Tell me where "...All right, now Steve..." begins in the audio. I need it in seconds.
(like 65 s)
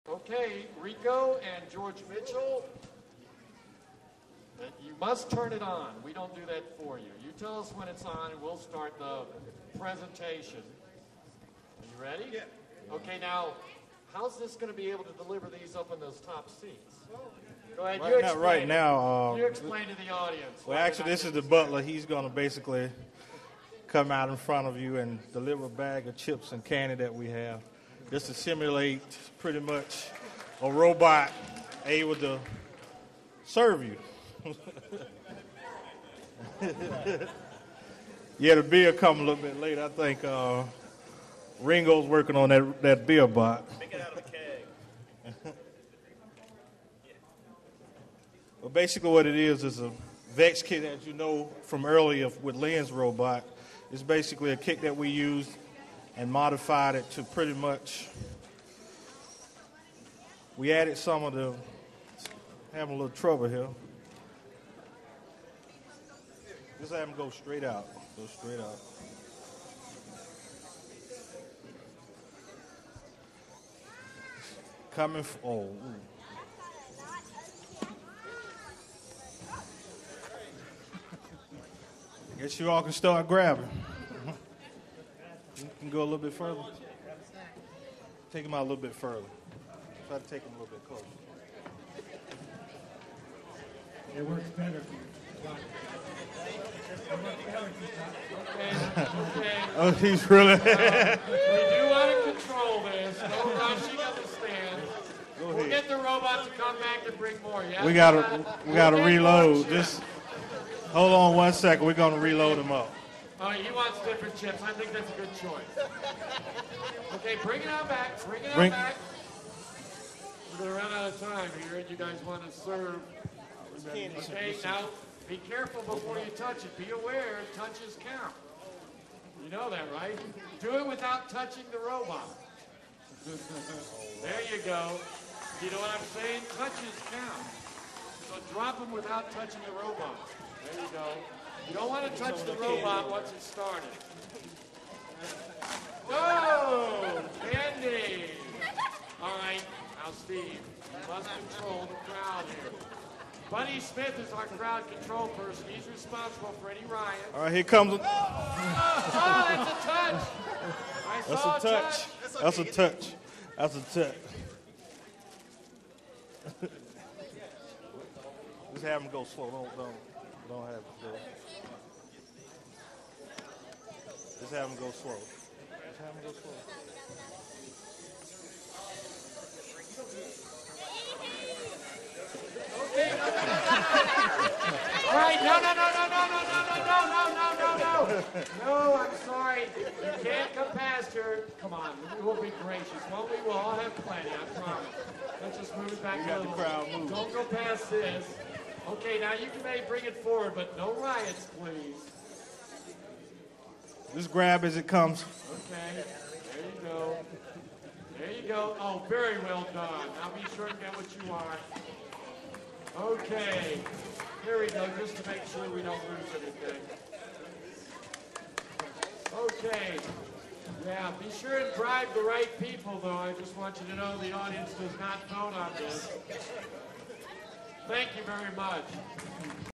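149 s.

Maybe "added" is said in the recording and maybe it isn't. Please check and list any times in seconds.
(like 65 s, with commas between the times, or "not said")
60 s.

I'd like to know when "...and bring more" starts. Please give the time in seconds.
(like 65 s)
107 s.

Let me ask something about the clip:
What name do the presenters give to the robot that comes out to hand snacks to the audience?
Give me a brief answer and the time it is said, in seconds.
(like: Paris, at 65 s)
the butler, at 21 s.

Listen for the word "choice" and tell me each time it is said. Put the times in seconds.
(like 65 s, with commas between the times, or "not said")
115 s.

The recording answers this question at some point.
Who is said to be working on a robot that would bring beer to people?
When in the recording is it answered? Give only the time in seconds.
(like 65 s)
41 s.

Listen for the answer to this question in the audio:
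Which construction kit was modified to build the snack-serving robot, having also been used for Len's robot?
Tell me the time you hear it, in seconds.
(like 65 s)
50 s.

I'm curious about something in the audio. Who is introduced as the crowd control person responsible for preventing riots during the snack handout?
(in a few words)
Buddy Smith.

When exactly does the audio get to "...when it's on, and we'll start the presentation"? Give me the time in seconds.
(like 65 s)
7 s.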